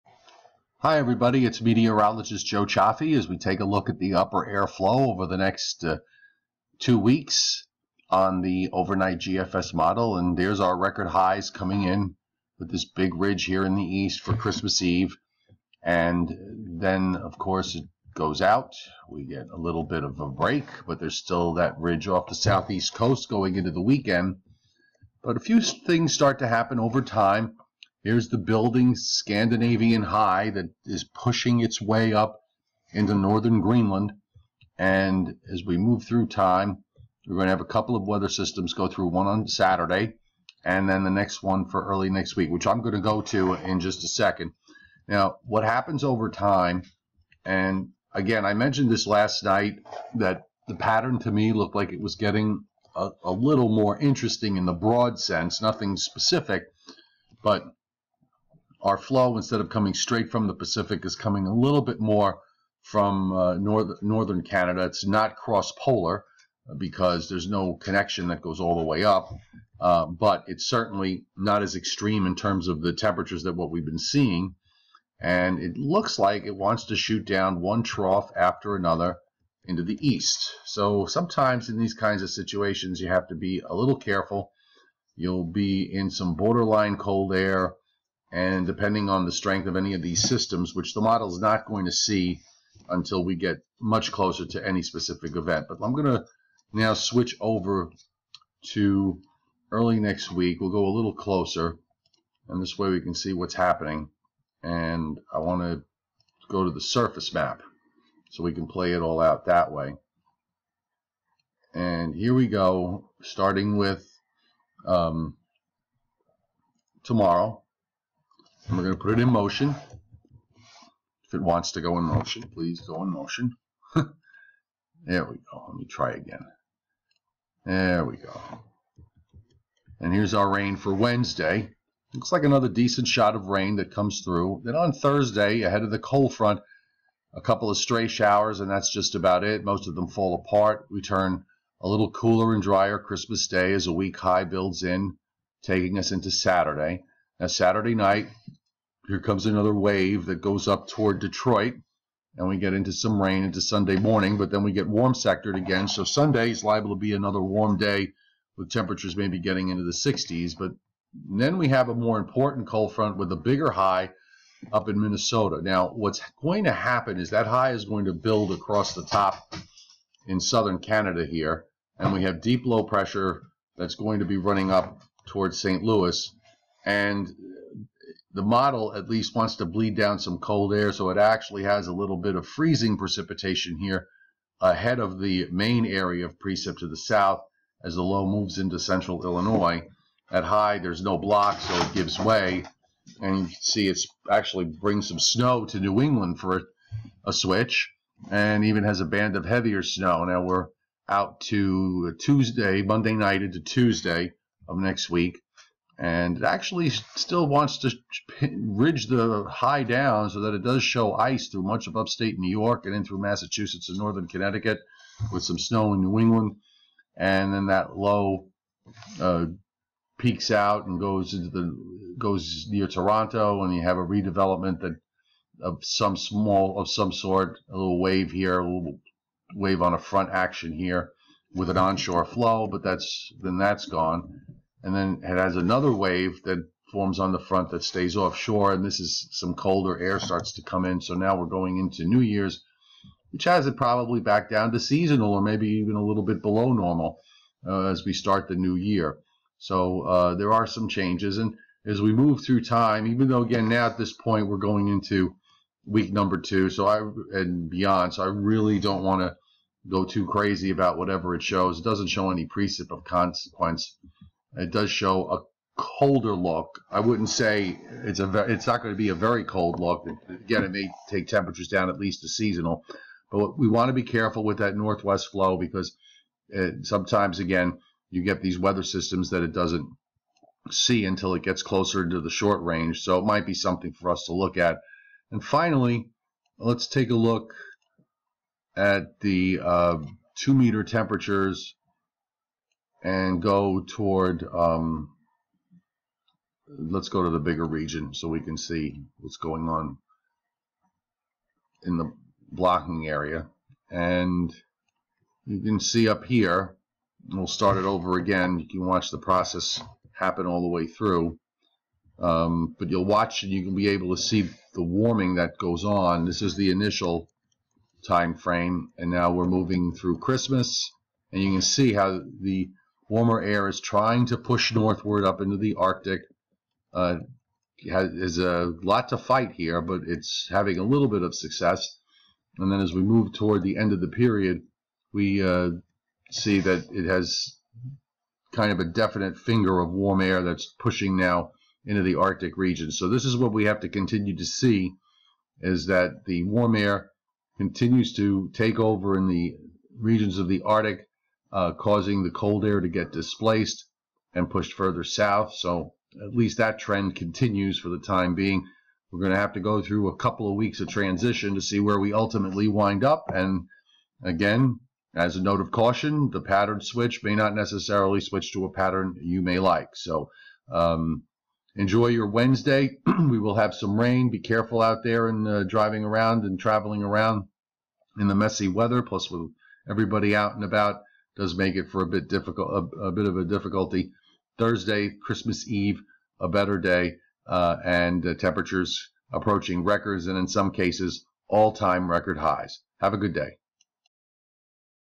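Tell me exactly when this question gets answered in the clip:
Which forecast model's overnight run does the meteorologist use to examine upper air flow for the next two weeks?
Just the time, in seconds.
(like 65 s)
9 s.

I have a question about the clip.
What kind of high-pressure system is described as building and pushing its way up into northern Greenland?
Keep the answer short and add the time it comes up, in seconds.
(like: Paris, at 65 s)
Scandinavian high, at 28 s.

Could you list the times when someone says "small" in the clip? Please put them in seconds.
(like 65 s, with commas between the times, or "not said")
226 s.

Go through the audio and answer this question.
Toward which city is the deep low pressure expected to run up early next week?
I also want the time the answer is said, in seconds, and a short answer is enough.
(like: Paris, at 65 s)
St. Louis, at 175 s.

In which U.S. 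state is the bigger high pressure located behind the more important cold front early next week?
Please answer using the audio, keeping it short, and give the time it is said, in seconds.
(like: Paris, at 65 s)
Minnesota, at 165 s.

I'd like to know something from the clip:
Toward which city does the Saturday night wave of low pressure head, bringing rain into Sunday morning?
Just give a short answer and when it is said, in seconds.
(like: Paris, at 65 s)
Detroit, at 151 s.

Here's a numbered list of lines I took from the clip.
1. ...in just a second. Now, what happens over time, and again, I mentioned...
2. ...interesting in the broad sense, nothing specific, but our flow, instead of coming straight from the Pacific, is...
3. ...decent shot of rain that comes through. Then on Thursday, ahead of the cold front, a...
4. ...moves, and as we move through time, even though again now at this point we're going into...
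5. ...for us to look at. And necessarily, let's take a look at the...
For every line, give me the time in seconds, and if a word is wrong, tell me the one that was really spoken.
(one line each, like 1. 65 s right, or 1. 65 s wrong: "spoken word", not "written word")
1. 43 s right
2. 53 s right
3. 132 s right
4. 250 s wrong: "changes", not "moves"
5. 283 s wrong: "finally", not "necessarily".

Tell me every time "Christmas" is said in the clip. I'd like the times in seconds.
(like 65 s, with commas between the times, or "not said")
14 s, 142 s, 320 s, 385 s.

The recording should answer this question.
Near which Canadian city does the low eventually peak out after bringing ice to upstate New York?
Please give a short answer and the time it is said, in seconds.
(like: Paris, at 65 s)
Toronto, at 222 s.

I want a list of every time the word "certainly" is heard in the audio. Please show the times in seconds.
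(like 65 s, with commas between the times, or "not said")
70 s.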